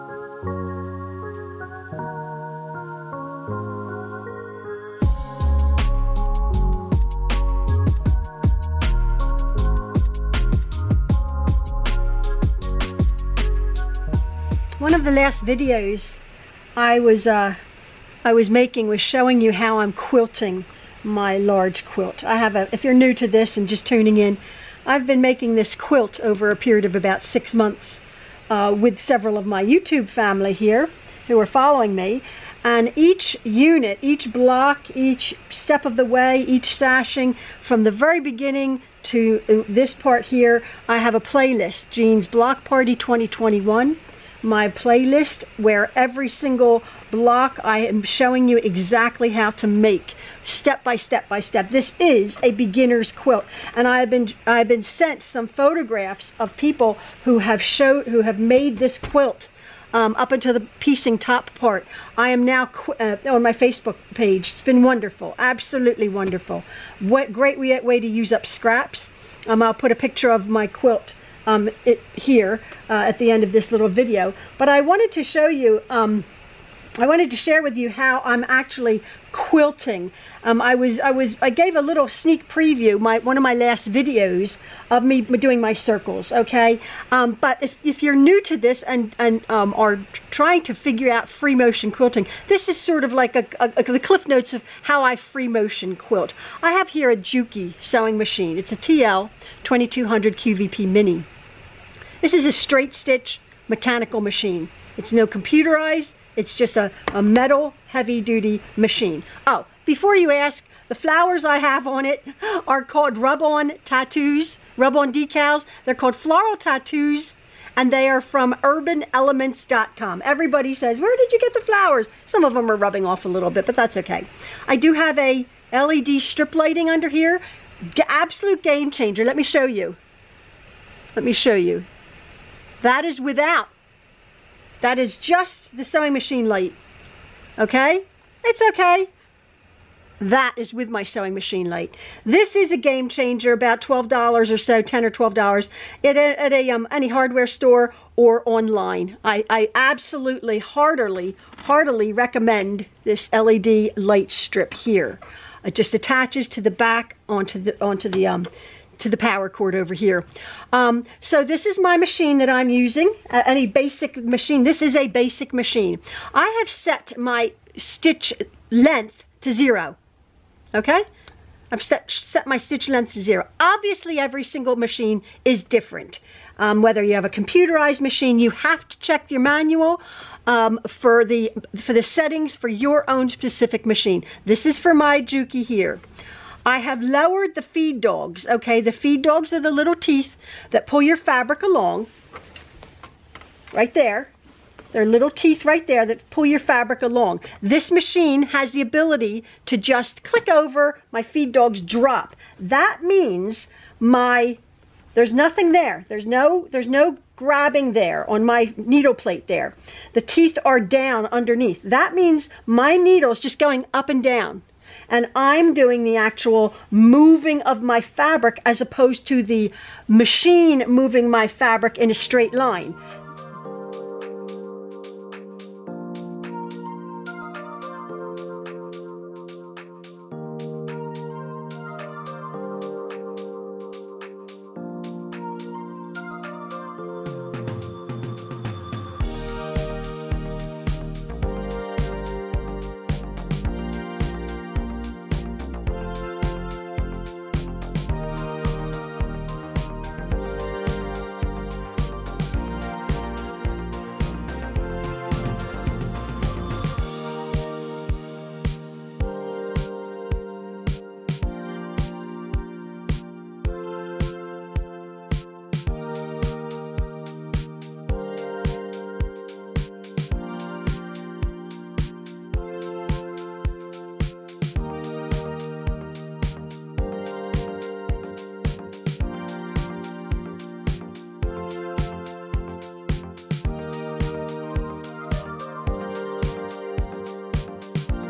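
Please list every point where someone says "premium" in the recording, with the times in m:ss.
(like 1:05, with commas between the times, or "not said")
not said.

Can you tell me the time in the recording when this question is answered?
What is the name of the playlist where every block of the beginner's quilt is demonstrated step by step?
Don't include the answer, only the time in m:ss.
0:41.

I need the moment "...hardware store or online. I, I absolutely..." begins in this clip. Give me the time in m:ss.
2:27.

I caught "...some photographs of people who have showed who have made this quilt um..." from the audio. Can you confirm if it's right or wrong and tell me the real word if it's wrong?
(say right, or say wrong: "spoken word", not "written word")
right.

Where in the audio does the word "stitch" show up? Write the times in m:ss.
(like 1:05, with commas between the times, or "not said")
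1:42, 2:47, 2:52.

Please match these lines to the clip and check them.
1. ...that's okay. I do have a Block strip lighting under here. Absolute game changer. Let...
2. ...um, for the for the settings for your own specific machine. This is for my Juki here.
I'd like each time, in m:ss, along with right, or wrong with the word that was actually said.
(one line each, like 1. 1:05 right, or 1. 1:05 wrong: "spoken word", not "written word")
1. 2:03 wrong: "LED", not "Block"
2. 3:00 right.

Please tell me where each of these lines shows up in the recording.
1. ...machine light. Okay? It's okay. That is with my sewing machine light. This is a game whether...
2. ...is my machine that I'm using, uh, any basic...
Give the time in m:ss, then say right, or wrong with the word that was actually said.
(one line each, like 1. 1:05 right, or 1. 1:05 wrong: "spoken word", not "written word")
1. 2:16 wrong: "changer", not "whether"
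2. 2:41 right.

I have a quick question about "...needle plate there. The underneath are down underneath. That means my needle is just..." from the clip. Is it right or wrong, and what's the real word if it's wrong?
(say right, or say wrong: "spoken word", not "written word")
wrong: "teeth", not "underneath".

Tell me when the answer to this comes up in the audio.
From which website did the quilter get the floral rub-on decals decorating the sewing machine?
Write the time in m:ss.
1:58.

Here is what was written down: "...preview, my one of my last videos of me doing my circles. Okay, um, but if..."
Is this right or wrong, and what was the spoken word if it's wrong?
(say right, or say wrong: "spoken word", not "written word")
right.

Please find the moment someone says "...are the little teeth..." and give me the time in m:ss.
3:09.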